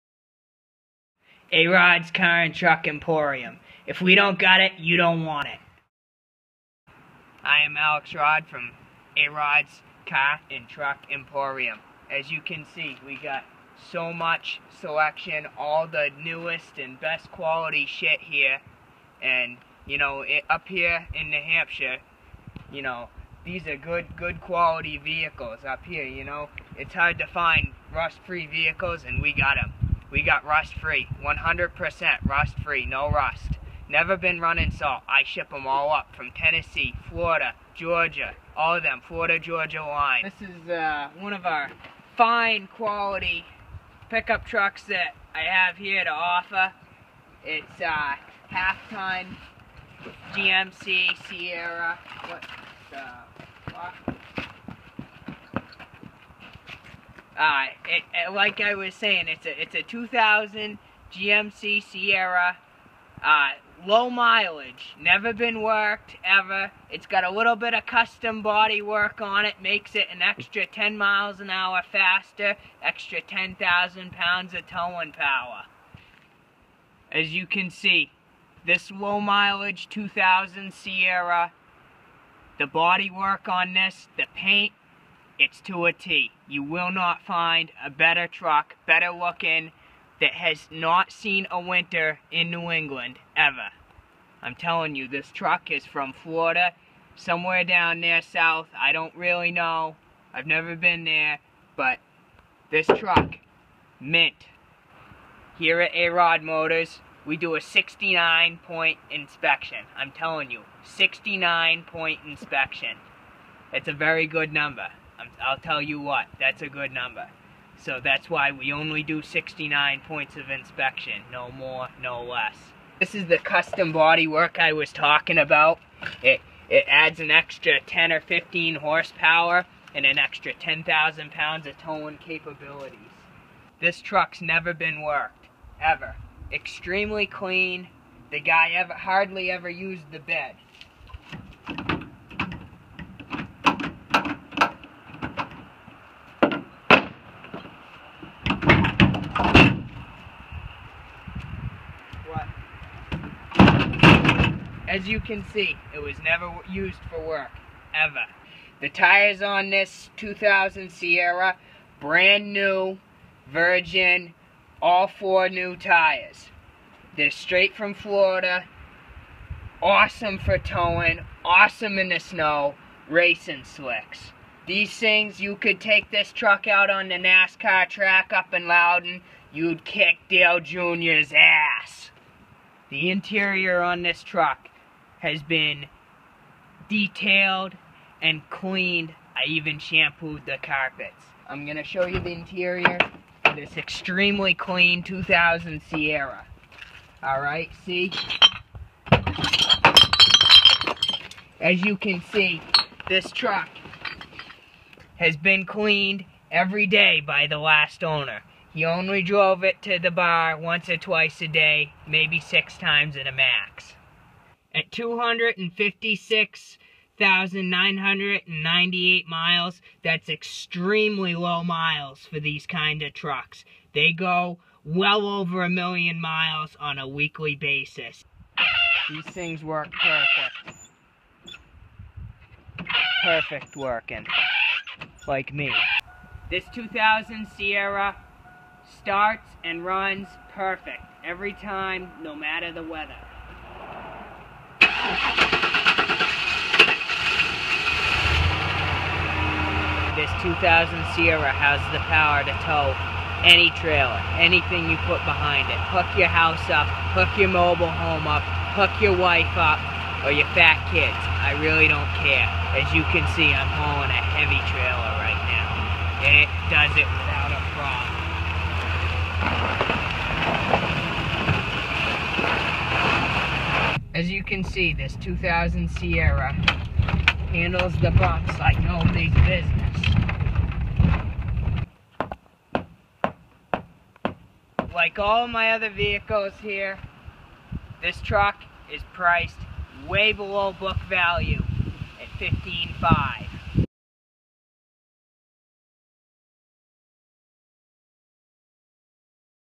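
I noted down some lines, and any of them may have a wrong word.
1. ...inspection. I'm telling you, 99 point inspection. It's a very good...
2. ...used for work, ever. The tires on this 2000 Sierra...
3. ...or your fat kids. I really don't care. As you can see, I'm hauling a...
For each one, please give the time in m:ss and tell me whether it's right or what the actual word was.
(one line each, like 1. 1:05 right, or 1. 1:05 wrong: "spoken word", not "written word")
1. 1:49 wrong: "69", not "99"
2. 2:36 right
3. 4:20 right.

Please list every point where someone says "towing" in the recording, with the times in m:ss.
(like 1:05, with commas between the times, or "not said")
1:14, 2:11, 2:50.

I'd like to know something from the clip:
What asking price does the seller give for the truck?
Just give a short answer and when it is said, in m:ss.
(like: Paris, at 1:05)
15.5, at 4:52.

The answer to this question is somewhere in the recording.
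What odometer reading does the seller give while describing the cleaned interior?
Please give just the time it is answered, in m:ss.
3:34.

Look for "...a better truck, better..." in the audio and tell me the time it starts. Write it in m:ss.
1:27.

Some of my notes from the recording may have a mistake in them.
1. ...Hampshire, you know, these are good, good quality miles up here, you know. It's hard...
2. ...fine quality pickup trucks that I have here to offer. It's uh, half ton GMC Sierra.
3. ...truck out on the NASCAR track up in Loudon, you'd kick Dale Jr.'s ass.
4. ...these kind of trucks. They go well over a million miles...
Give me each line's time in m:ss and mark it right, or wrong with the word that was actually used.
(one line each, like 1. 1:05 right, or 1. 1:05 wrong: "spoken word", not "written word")
1. 0:21 wrong: "vehicles", not "miles"
2. 0:42 right
3. 2:56 right
4. 3:42 right.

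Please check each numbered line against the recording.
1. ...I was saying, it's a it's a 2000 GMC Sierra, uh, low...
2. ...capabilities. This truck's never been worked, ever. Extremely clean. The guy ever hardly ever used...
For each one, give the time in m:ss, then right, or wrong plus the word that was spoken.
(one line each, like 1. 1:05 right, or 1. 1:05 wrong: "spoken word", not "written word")
1. 0:58 right
2. 2:12 right.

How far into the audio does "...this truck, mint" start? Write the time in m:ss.
1:42.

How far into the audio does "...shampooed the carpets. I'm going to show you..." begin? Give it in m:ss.
3:09.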